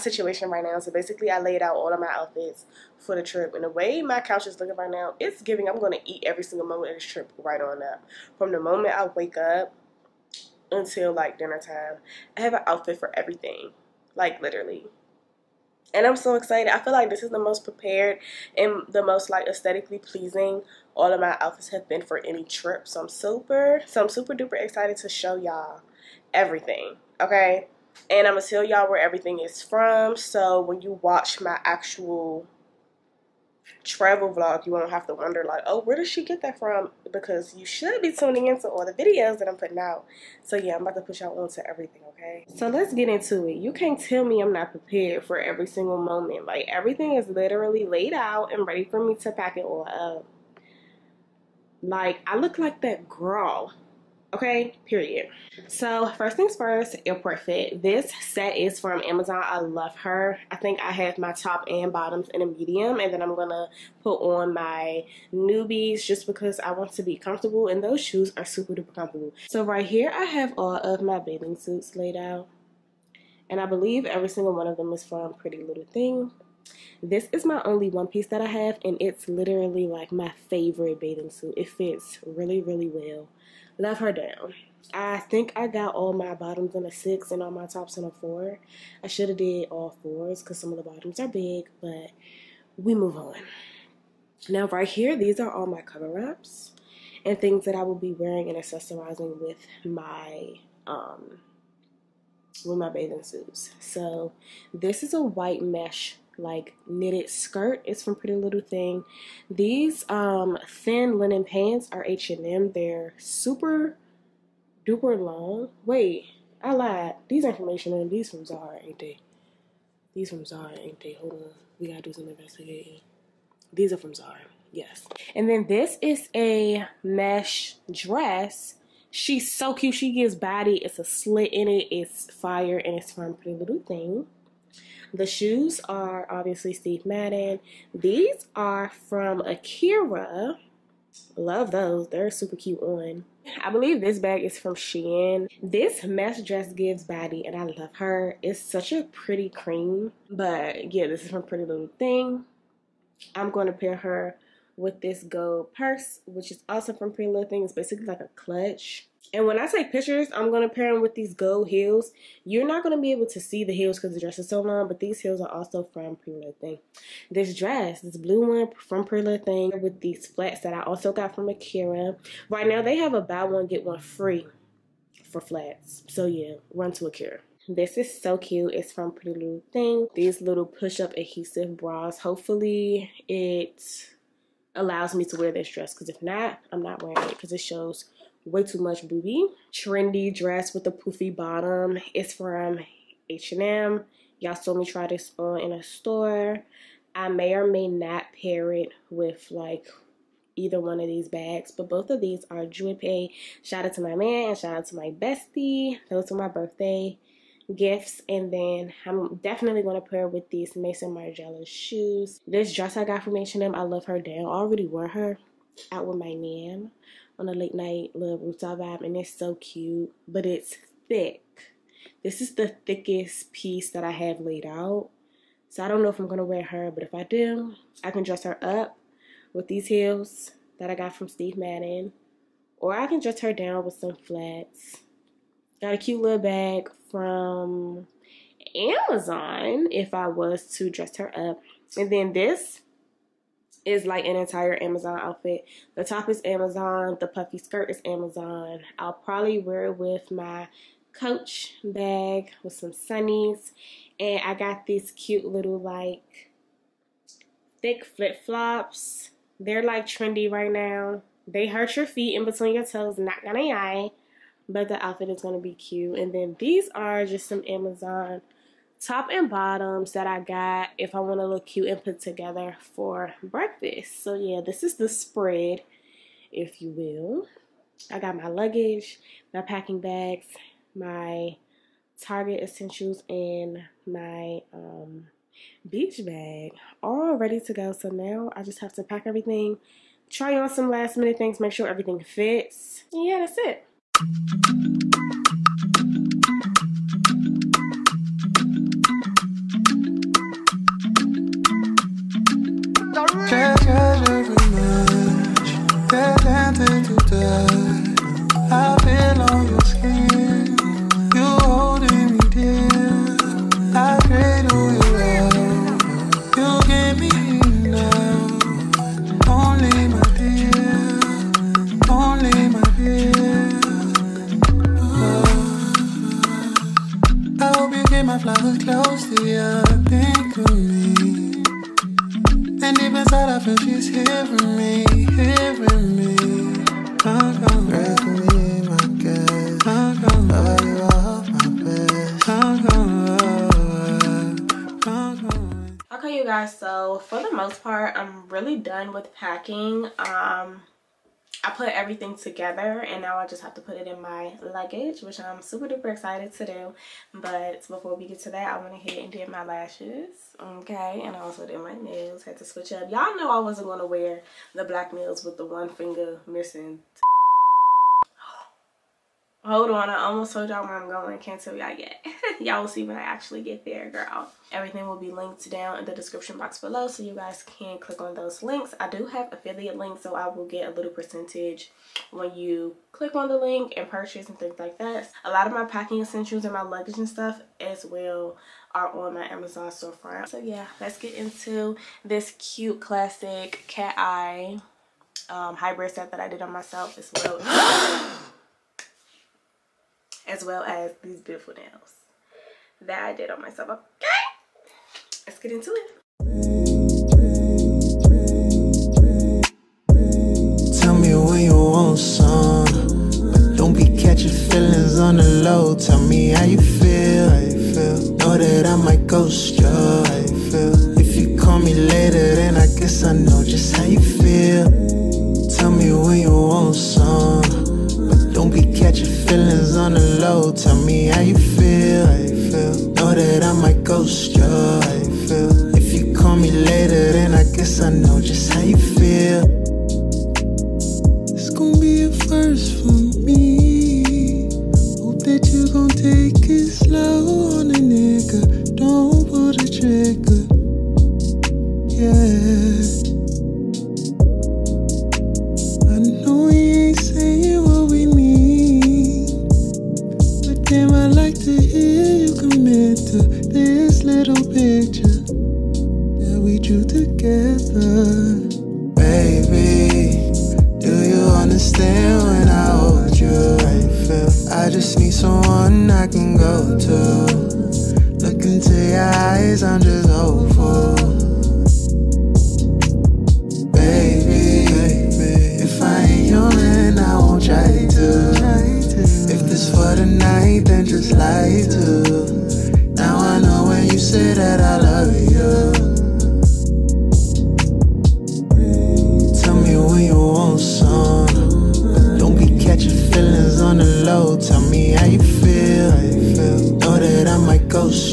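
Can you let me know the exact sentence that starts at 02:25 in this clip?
This mesh dress gives body and I love her.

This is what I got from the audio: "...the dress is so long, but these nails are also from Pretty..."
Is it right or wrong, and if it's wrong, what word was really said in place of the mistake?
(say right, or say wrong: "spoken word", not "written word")
wrong: "heels", not "nails".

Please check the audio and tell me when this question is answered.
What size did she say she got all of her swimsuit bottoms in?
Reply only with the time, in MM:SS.
01:25.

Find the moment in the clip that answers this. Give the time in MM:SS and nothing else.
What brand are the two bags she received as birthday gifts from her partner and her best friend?
03:21.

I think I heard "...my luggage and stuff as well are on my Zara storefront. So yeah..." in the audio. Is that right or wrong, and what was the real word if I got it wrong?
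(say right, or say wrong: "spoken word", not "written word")
wrong: "Amazon", not "Zara".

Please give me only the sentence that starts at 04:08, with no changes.
I'll probably wear it with my coach bag with some sunnies.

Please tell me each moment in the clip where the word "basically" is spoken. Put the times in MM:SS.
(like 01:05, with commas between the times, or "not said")
00:00, 02:37.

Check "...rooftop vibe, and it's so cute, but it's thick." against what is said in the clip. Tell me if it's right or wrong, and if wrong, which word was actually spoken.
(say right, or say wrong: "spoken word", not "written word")
right.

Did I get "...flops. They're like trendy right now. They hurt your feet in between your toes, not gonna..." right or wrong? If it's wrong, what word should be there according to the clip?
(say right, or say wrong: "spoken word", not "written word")
right.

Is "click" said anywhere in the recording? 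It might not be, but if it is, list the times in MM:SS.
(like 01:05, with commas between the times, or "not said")
06:17, 06:23.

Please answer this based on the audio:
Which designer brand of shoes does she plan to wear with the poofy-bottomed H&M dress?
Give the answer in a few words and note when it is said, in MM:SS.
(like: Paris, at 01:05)
Maison Margiela, at 03:30.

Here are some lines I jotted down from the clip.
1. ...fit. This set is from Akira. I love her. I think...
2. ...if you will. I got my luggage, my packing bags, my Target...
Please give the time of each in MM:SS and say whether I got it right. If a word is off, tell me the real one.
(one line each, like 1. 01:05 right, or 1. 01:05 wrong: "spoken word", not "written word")
1. 00:57 wrong: "Amazon", not "Akira"
2. 04:36 right.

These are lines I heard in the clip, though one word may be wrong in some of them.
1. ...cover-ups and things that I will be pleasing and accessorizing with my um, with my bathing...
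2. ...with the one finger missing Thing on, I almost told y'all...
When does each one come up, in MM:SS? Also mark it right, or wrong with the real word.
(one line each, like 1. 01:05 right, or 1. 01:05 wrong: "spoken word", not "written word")
1. 01:35 wrong: "wearing", not "pleasing"
2. 06:05 wrong: "Hold", not "Thing".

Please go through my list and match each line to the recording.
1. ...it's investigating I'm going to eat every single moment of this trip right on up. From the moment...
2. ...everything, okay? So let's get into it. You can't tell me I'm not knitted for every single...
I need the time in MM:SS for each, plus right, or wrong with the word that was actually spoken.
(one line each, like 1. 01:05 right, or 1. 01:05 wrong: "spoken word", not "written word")
1. 00:05 wrong: "giving", not "investigating"
2. 00:41 wrong: "prepared", not "knitted".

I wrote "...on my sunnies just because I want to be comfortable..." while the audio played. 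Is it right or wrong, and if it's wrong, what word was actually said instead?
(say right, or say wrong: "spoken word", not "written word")
wrong: "newbies", not "sunnies".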